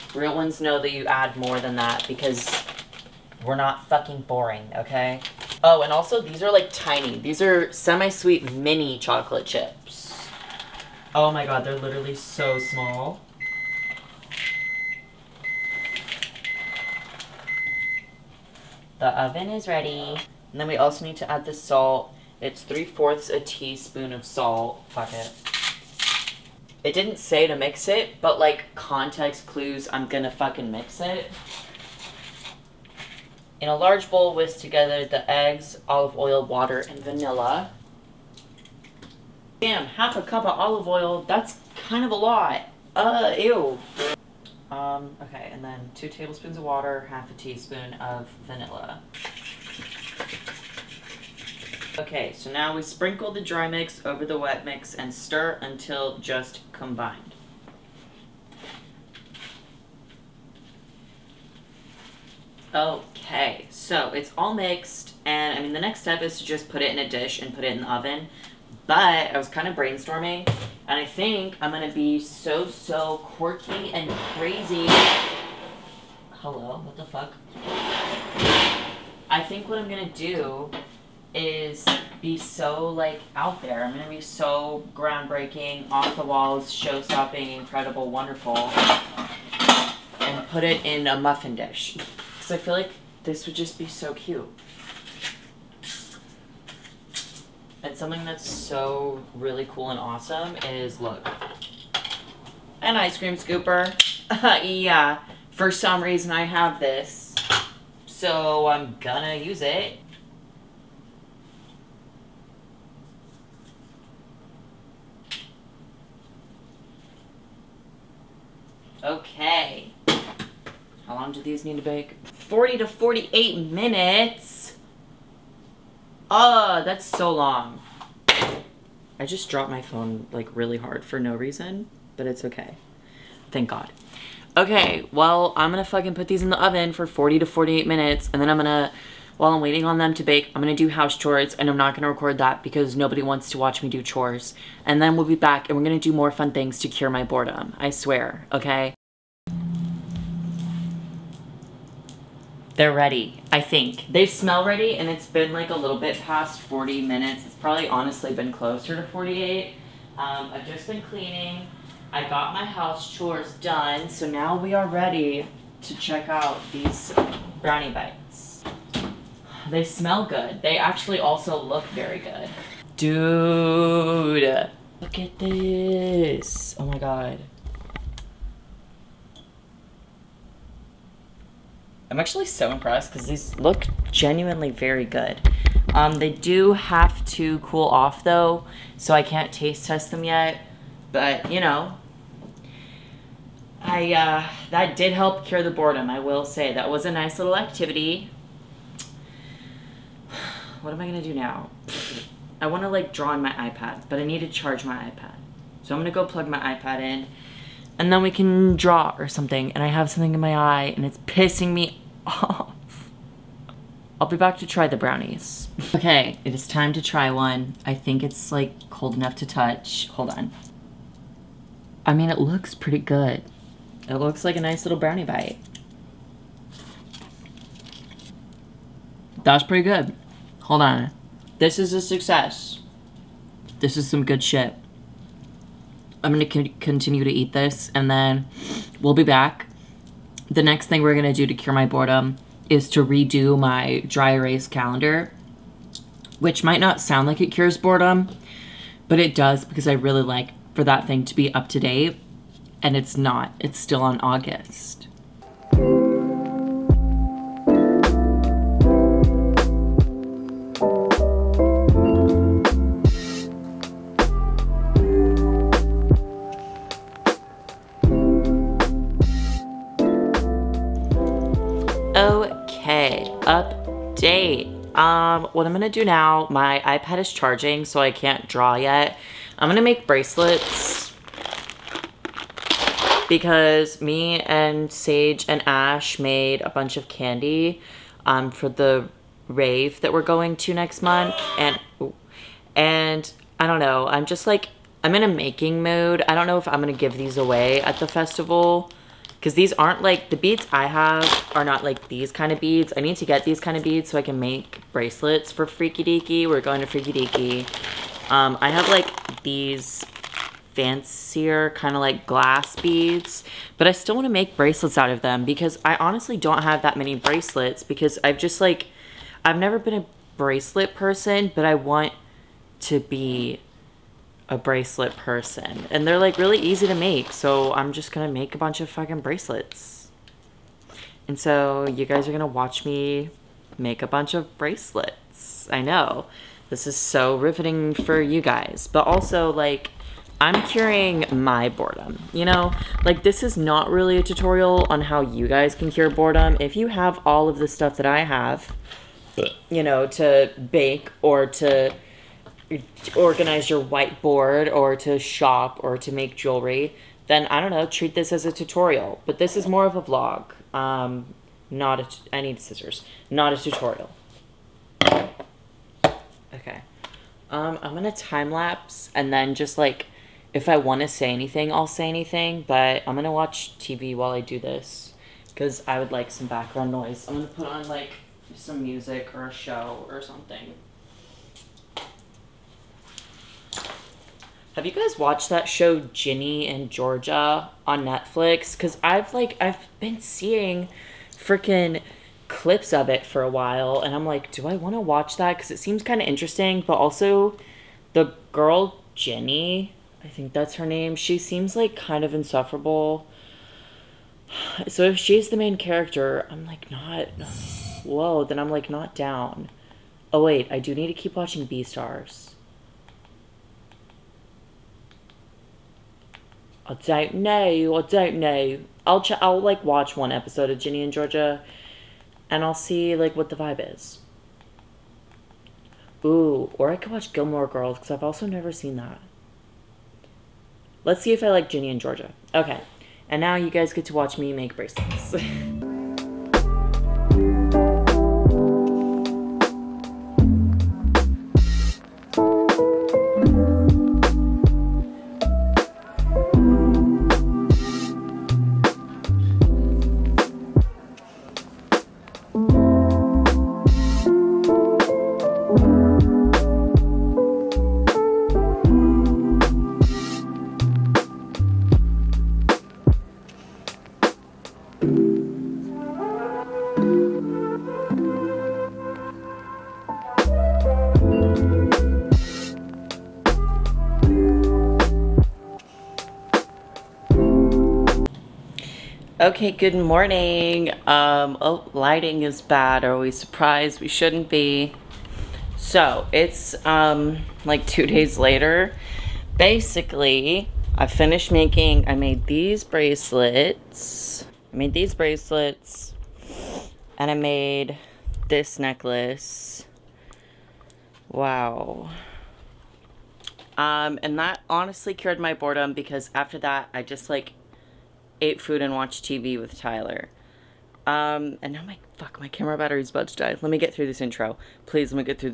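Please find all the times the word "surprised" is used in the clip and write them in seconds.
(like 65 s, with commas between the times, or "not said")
483 s.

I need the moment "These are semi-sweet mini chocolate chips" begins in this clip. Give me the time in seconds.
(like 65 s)
7 s.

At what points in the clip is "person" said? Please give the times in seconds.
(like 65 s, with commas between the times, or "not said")
320 s, 325 s.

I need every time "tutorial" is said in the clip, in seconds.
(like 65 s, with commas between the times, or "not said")
344 s, 358 s, 363 s.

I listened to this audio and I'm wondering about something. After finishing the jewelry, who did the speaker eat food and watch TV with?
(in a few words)
Tyler.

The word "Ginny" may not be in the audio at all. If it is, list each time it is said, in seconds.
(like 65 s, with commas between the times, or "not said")
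385 s, 399 s, 420 s, 431 s.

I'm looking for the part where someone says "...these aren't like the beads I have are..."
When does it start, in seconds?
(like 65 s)
299 s.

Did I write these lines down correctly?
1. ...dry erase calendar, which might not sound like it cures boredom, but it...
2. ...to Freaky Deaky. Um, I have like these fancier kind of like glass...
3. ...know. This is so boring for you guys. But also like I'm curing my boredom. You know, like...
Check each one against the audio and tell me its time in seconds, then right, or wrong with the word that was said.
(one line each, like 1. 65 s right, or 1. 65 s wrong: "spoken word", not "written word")
1. 244 s right
2. 306 s right
3. 335 s wrong: "riveting", not "boring".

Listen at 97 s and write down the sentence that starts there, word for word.
And something that's so really cool and awesome is, look, an ice cream scooper.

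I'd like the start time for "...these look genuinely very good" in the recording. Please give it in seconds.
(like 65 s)
183 s.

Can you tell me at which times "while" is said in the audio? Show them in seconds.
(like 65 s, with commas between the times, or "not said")
139 s, 374 s, 393 s.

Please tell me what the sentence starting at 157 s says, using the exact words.
It's probably honestly been closer to 48.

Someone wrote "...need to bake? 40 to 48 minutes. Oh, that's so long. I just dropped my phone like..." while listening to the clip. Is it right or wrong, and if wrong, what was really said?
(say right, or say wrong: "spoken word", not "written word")
right.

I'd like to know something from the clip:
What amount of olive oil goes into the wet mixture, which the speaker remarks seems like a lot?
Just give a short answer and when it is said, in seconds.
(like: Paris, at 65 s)
half a cup, at 39 s.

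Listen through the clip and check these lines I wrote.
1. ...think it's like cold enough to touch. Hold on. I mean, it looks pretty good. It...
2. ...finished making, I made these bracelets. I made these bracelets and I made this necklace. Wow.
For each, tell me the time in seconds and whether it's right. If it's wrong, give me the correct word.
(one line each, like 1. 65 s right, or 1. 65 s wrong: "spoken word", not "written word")
1. 217 s right
2. 491 s right.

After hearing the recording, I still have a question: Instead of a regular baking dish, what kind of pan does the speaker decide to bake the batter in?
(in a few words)
muffin dish.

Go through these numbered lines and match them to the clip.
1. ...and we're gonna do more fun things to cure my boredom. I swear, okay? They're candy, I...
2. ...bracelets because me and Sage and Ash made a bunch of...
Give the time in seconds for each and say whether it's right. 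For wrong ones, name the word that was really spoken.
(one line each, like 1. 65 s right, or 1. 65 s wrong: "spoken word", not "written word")
1. 145 s wrong: "ready", not "candy"
2. 280 s right.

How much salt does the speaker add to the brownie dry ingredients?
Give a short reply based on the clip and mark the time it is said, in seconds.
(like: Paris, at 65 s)
3/4 teaspoon, at 22 s.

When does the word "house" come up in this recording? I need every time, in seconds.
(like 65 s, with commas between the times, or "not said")
140 s, 162 s.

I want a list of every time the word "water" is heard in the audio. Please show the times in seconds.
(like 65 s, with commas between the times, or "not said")
36 s, 46 s.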